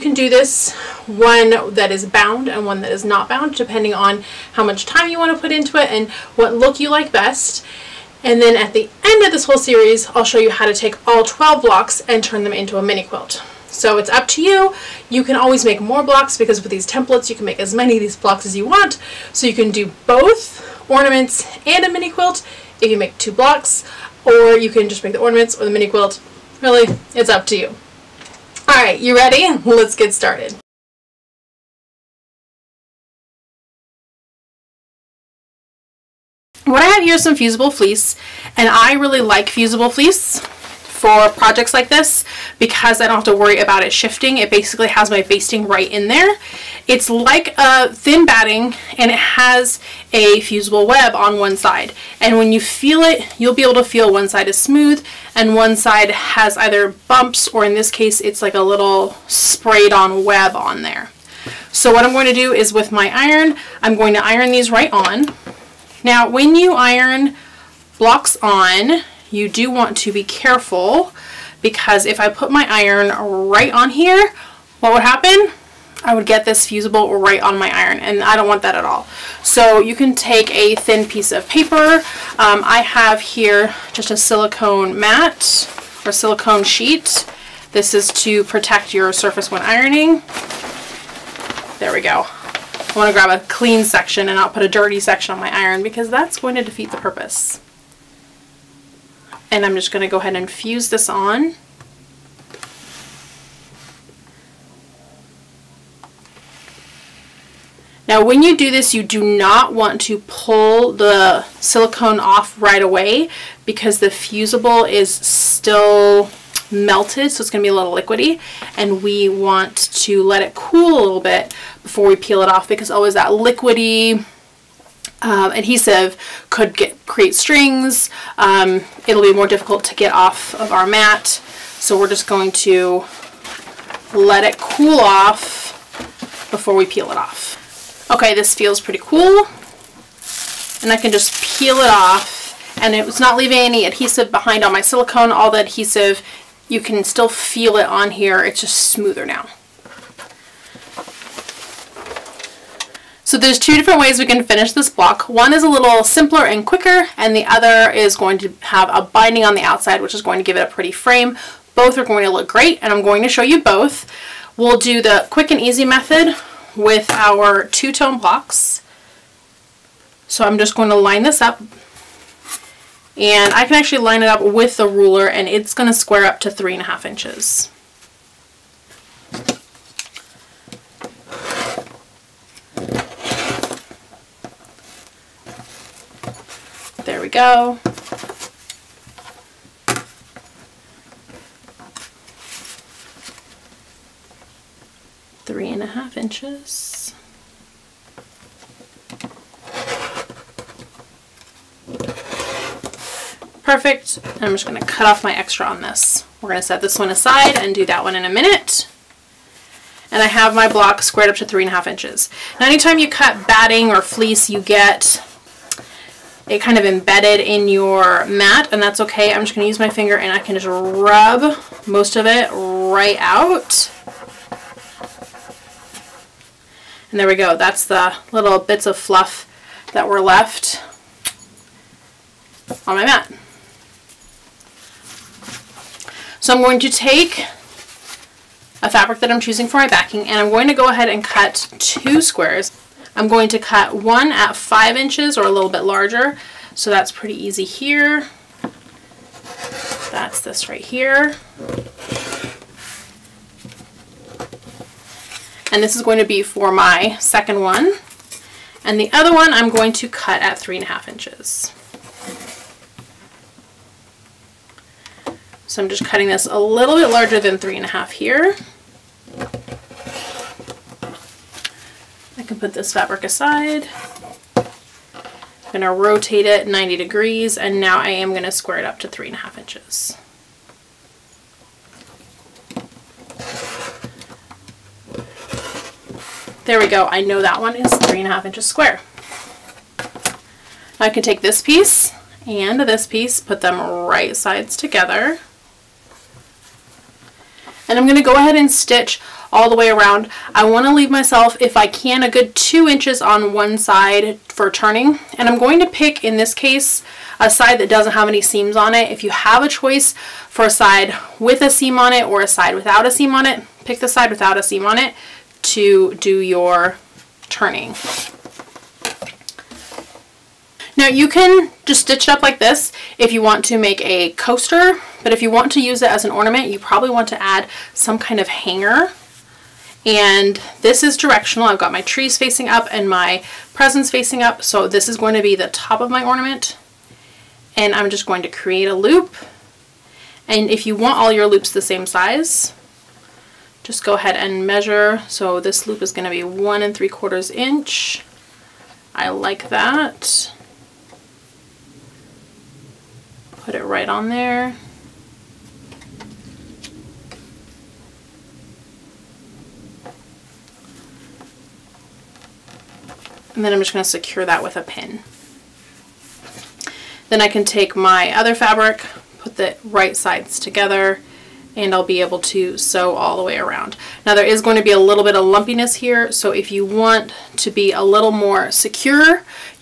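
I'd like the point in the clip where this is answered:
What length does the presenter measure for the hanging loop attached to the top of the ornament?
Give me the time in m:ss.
5:46.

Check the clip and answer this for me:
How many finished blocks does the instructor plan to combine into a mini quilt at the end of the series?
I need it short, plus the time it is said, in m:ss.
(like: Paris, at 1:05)
12, at 0:11.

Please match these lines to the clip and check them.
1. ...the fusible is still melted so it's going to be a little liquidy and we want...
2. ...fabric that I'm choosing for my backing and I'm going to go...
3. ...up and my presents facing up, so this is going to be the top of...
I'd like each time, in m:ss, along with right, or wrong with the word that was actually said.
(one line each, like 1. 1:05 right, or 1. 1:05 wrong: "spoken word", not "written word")
1. 1:53 right
2. 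3:58 right
3. 5:32 right.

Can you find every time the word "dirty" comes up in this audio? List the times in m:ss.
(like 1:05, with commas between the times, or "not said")
1:34.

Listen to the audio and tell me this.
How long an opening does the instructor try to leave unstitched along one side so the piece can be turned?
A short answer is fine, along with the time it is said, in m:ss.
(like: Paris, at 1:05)
2 inches, at 5:02.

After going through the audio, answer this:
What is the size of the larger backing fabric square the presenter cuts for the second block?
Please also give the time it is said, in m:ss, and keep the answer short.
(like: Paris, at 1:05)
5 inches, at 4:04.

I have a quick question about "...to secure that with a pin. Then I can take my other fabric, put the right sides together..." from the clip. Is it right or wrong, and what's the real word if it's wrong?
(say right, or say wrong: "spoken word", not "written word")
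right.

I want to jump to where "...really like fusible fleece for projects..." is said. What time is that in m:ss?
0:38.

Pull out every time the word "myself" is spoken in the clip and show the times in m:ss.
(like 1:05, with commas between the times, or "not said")
5:01.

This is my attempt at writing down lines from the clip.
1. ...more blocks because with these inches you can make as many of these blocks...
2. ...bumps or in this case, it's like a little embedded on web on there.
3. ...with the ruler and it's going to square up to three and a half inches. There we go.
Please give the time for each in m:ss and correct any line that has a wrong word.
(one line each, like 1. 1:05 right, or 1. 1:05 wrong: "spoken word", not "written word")
1. 0:15 wrong: "templates", not "inches"
2. 0:57 wrong: "sprayed", not "embedded"
3. 2:54 right.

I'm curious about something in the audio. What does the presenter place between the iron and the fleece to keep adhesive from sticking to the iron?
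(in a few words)
silicone mat.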